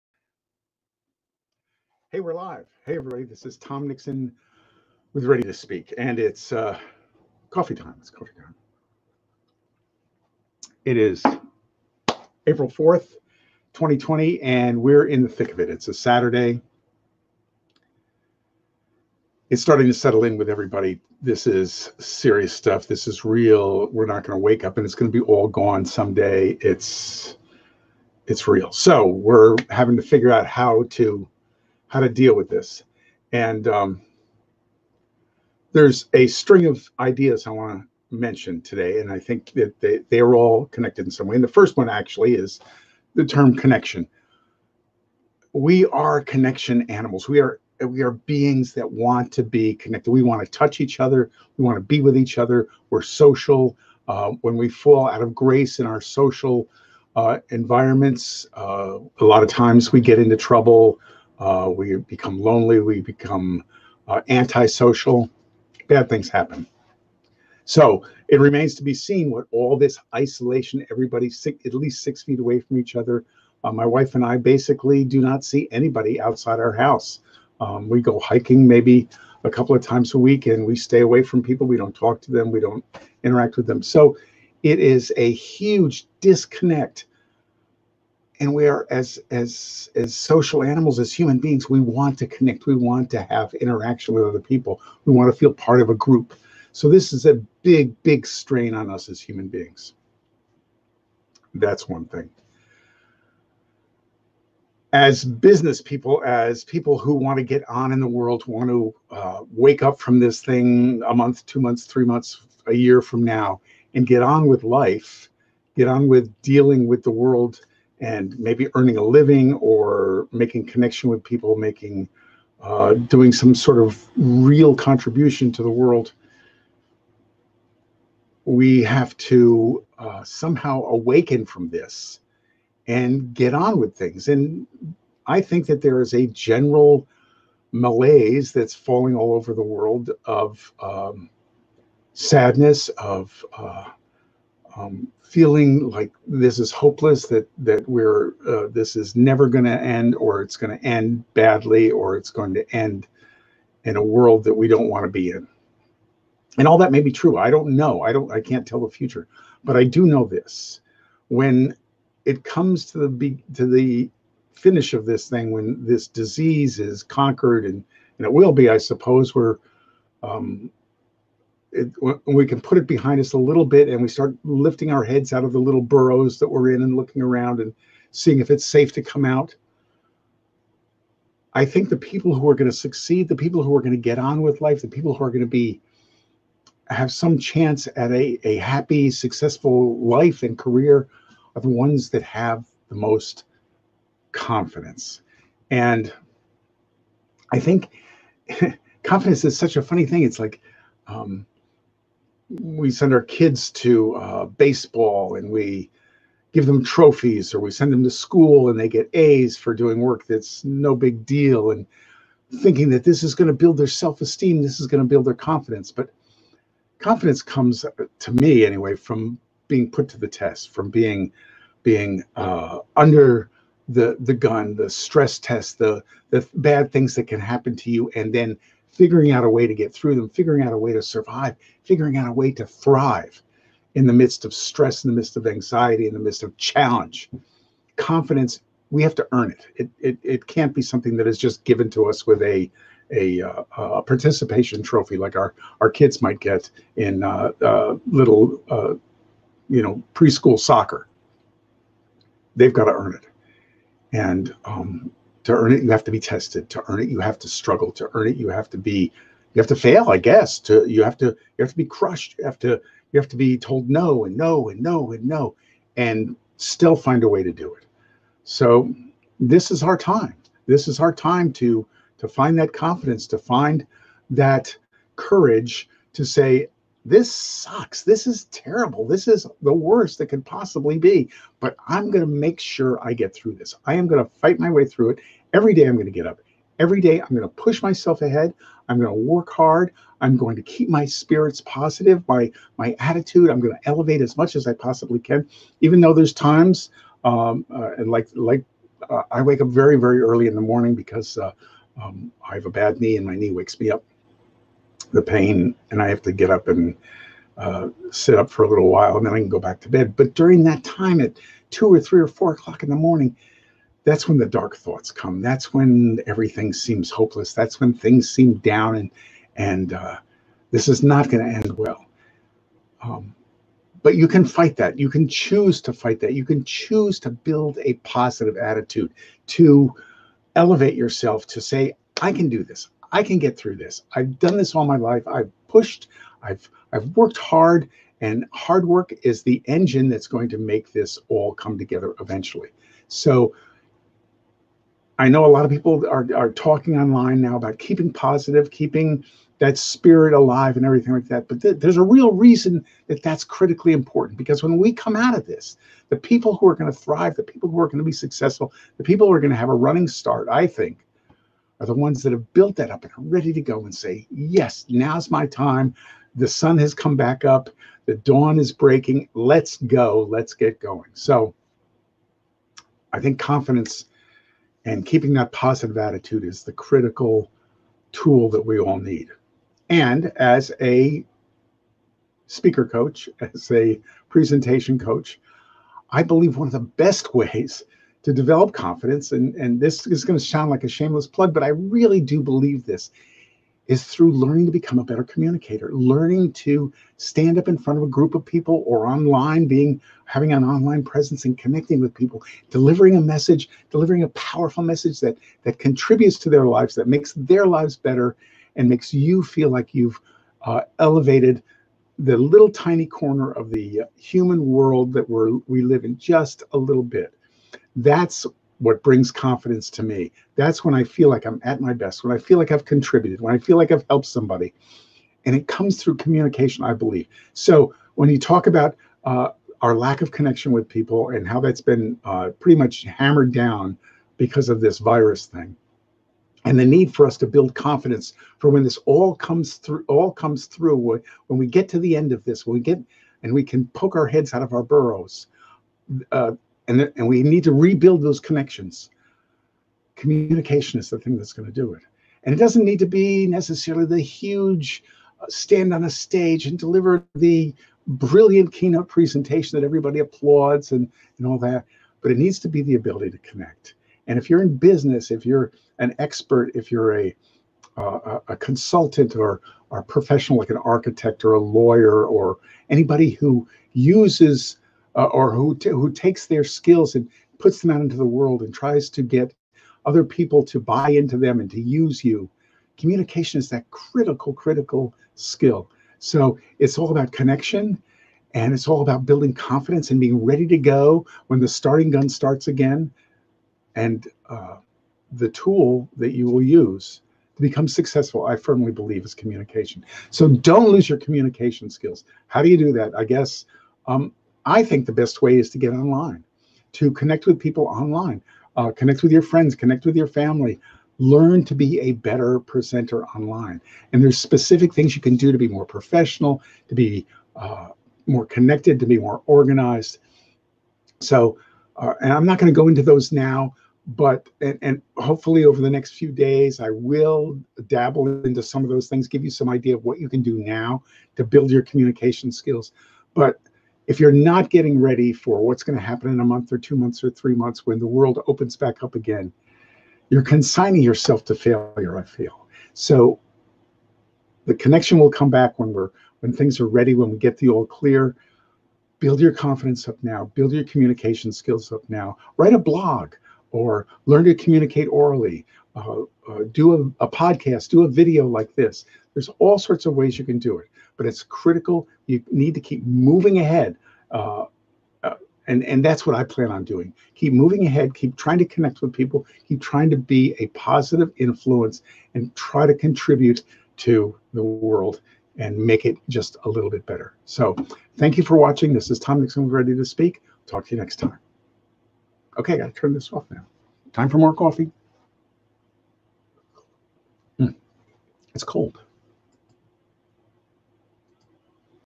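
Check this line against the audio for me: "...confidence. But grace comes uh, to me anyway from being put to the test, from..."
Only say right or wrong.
wrong.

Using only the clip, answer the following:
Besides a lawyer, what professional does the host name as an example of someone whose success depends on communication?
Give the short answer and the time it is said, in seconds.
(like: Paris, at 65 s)
An architect, at 470 s.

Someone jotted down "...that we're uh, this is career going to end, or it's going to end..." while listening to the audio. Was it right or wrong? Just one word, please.
wrong.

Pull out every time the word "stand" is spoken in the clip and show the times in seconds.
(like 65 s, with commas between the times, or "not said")
397 s, 455 s.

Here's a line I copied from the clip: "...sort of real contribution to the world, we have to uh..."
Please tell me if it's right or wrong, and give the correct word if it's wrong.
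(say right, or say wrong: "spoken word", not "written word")
right.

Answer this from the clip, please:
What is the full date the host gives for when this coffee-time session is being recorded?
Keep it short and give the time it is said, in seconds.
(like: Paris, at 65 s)
April 4th, 2020, at 12 s.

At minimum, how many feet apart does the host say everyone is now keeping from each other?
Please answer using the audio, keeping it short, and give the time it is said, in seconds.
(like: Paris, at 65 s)
6 feet, at 72 s.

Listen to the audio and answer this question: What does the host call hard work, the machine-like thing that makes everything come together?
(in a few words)
The engine.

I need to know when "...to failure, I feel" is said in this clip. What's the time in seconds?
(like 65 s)
541 s.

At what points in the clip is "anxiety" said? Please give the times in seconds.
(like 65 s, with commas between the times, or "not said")
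235 s.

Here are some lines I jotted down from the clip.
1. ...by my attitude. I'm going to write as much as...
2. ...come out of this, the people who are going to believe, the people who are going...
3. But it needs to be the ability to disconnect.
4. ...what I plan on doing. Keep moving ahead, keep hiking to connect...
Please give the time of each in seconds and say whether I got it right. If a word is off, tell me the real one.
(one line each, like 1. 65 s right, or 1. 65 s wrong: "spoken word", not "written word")
1. 292 s wrong: "elevate", not "write"
2. 354 s wrong: "thrive", not "believe"
3. 462 s wrong: "connect", not "disconnect"
4. 566 s wrong: "trying", not "hiking".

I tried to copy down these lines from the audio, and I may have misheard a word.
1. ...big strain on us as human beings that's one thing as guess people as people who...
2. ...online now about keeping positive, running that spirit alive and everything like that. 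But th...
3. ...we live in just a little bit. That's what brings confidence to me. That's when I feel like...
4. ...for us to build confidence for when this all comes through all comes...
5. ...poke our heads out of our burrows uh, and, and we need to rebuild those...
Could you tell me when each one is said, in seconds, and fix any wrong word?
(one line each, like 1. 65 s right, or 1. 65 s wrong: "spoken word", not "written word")
1. 98 s wrong: "business", not "guess"
2. 346 s wrong: "keeping", not "running"
3. 415 s right
4. 437 s right
5. 443 s right.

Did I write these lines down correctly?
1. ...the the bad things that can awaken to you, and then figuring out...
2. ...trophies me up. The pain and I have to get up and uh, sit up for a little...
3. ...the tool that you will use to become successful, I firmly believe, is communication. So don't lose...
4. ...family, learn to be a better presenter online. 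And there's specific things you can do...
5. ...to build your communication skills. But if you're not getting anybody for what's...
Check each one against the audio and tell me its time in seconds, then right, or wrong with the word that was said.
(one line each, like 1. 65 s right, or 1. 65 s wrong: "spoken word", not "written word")
1. 225 s wrong: "happen", not "awaken"
2. 303 s wrong: "wakes", not "trophies"
3. 495 s right
4. 510 s right
5. 531 s wrong: "ready", not "anybody".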